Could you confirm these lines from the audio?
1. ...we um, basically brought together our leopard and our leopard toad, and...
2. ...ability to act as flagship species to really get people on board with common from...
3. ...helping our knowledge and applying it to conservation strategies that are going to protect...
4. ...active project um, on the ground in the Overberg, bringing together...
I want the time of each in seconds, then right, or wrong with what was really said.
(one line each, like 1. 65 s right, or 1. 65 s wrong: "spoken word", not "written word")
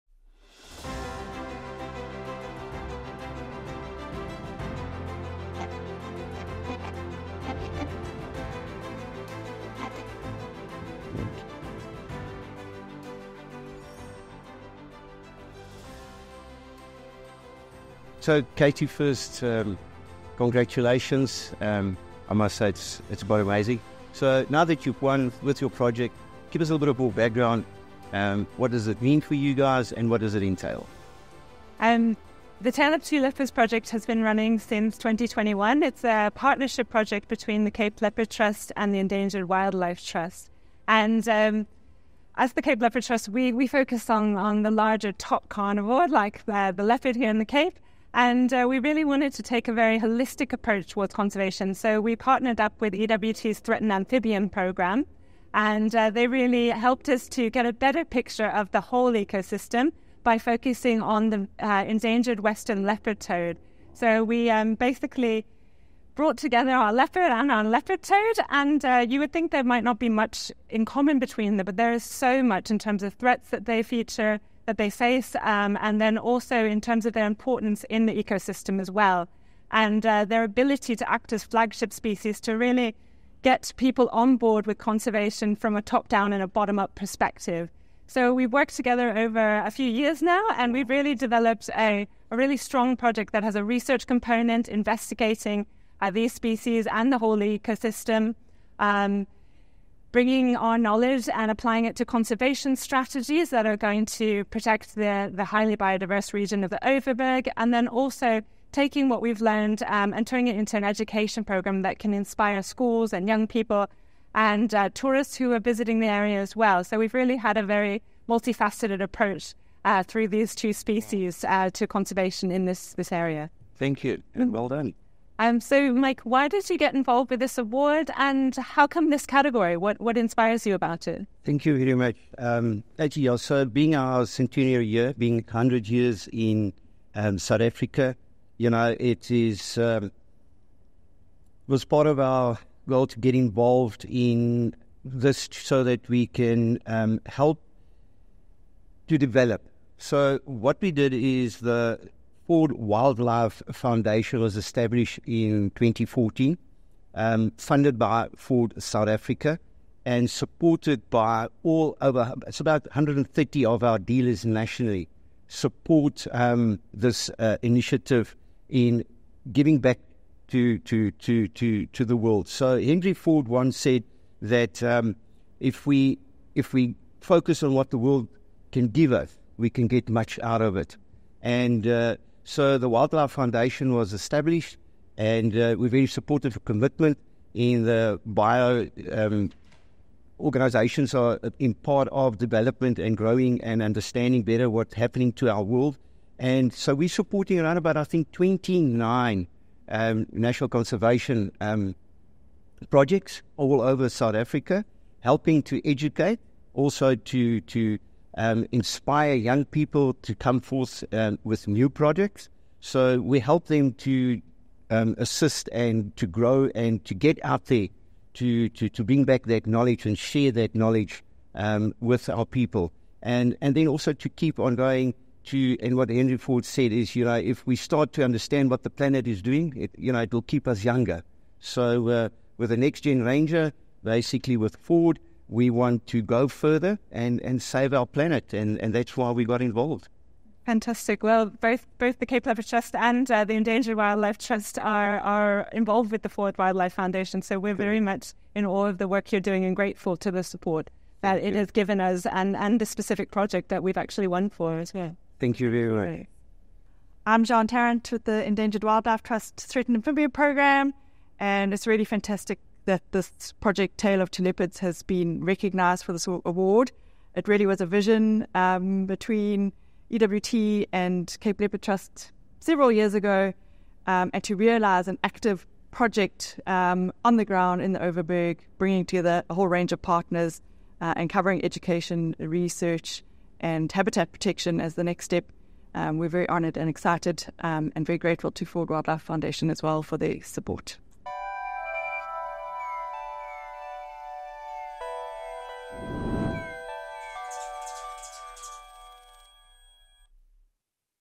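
1. 64 s right
2. 80 s wrong: "conservation", not "common"
3. 100 s wrong: "bringing", not "helping"
4. 275 s right.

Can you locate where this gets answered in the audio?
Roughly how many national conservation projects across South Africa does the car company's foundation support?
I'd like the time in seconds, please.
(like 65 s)
198 s.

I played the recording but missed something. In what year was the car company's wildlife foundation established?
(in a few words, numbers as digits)
2014.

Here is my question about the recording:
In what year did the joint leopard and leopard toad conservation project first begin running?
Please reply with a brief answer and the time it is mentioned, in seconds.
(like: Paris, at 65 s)
2021, at 34 s.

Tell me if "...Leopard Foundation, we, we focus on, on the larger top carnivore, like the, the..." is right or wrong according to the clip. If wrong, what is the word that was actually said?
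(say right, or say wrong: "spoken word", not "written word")
wrong: "Trust", not "Foundation".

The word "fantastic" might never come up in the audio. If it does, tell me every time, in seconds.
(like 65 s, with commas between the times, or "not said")
240 s, 262 s.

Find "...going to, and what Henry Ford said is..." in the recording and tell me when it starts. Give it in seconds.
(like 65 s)
224 s.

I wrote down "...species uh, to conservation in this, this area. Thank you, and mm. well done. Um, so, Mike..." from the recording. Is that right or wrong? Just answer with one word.
right.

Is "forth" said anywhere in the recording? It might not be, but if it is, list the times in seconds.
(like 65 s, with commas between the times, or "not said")
210 s.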